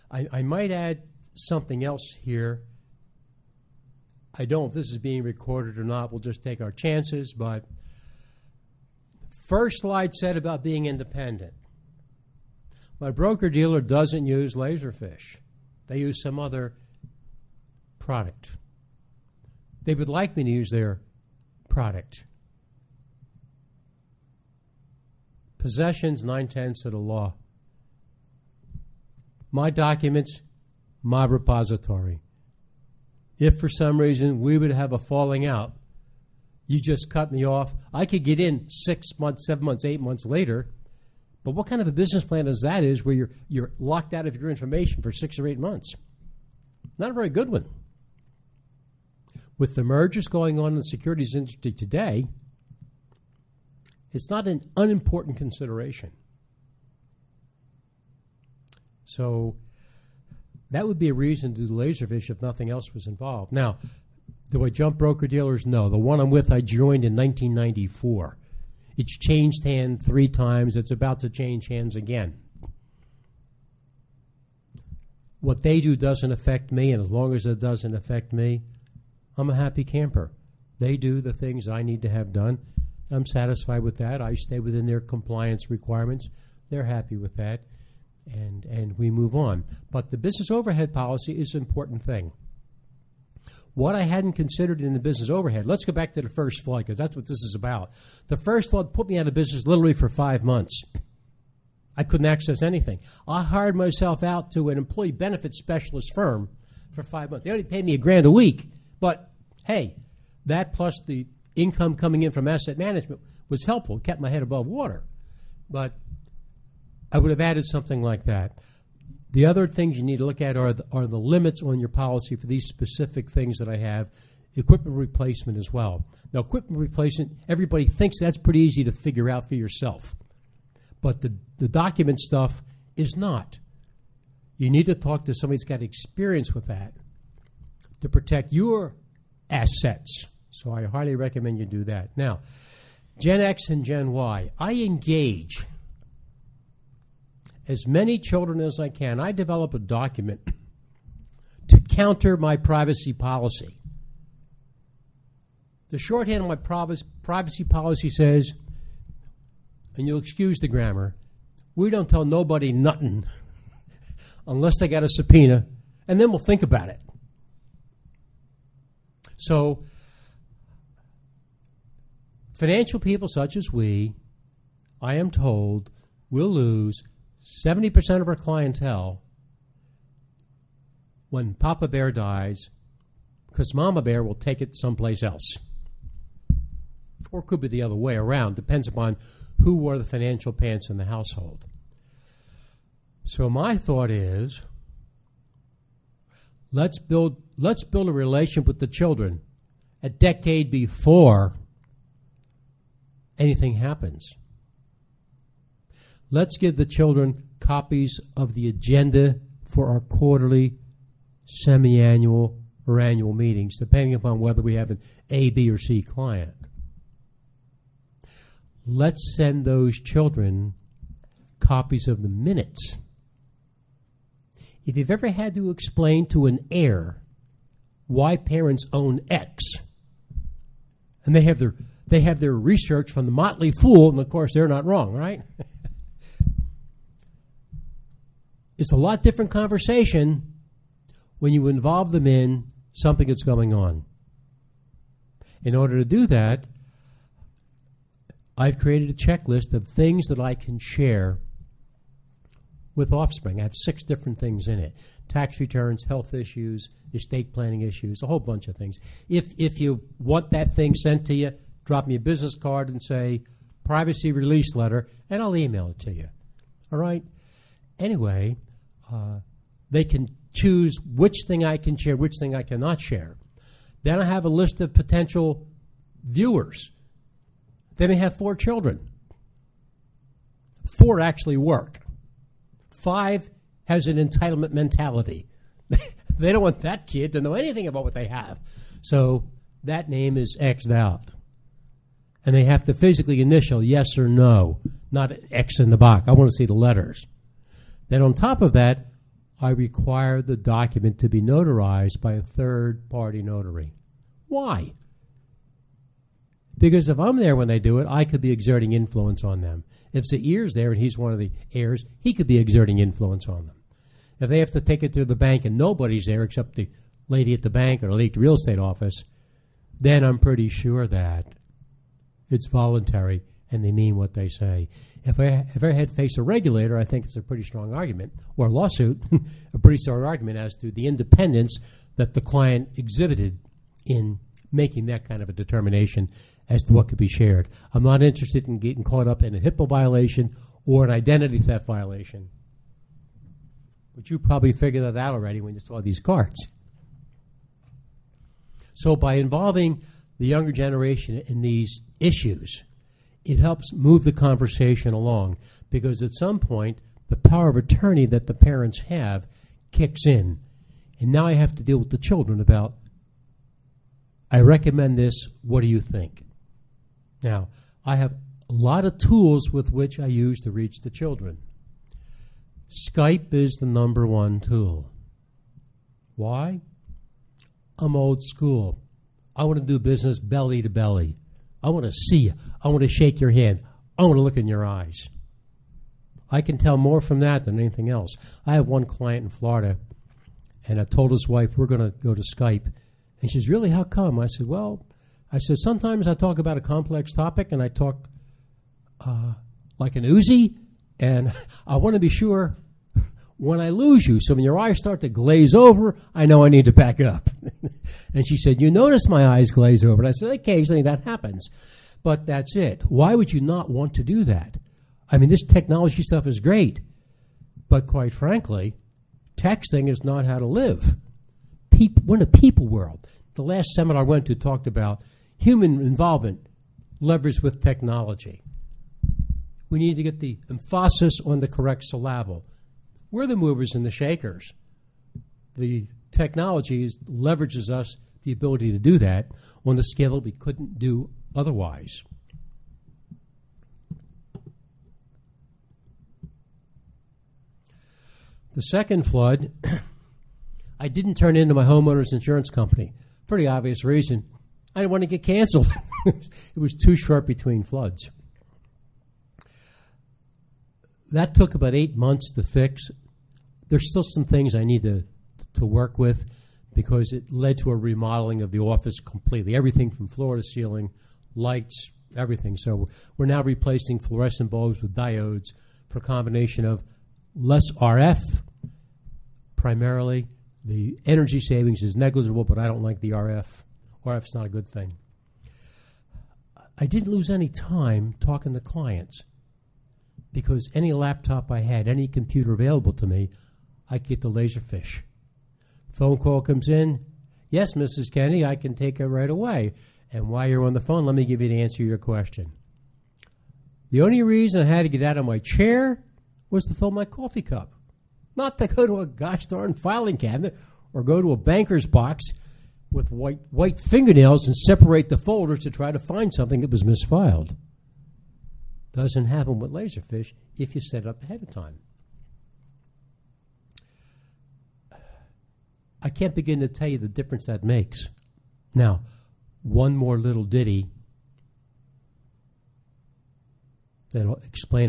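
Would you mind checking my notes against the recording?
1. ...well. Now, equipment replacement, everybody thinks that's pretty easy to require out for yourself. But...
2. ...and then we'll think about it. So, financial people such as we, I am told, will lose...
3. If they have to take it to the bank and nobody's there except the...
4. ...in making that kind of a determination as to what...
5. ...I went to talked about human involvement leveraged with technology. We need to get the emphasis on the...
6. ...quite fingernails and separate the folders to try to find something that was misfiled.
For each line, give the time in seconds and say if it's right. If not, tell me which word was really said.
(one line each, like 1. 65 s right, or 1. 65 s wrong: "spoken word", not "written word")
1. 125 s wrong: "figure", not "require"
2. 166 s right
3. 314 s right
4. 334 s right
5. 424 s right
6. 513 s wrong: "white", not "quite".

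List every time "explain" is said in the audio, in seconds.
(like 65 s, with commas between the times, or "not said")
225 s, 534 s.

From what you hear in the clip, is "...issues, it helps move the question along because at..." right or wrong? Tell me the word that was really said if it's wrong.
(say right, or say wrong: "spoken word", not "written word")
wrong: "conversation", not "question".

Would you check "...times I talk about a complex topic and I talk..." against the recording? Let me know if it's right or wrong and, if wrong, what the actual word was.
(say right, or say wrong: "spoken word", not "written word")
wrong: "sometimes", not "times".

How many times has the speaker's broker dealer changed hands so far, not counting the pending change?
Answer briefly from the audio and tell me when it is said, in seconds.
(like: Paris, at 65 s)
3, at 70 s.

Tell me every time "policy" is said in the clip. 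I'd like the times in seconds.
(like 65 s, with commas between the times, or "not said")
90 s, 121 s, 153 s, 157 s.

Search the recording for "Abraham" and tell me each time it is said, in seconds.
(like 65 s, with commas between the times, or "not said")
not said.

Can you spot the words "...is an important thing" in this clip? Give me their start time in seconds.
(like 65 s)
91 s.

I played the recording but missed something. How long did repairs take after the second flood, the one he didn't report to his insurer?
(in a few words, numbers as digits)
About 8 months.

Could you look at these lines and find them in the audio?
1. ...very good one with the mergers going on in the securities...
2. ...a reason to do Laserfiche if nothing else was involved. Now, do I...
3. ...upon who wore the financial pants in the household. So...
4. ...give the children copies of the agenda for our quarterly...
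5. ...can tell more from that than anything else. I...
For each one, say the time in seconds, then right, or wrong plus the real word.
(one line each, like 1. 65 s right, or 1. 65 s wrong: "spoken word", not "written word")
1. 47 s right
2. 61 s right
3. 188 s right
4. 206 s right
5. 386 s right.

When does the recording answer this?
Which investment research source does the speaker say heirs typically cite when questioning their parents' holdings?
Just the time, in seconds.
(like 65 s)
233 s.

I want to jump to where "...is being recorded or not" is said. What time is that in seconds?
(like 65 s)
4 s.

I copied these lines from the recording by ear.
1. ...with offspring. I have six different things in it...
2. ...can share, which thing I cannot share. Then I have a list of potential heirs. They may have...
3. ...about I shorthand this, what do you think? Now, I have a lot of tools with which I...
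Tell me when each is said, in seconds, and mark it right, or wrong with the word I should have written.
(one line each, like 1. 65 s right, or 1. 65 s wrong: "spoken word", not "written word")
1. 252 s right
2. 271 s wrong: "viewers", not "heirs"
3. 362 s wrong: "recommend", not "shorthand".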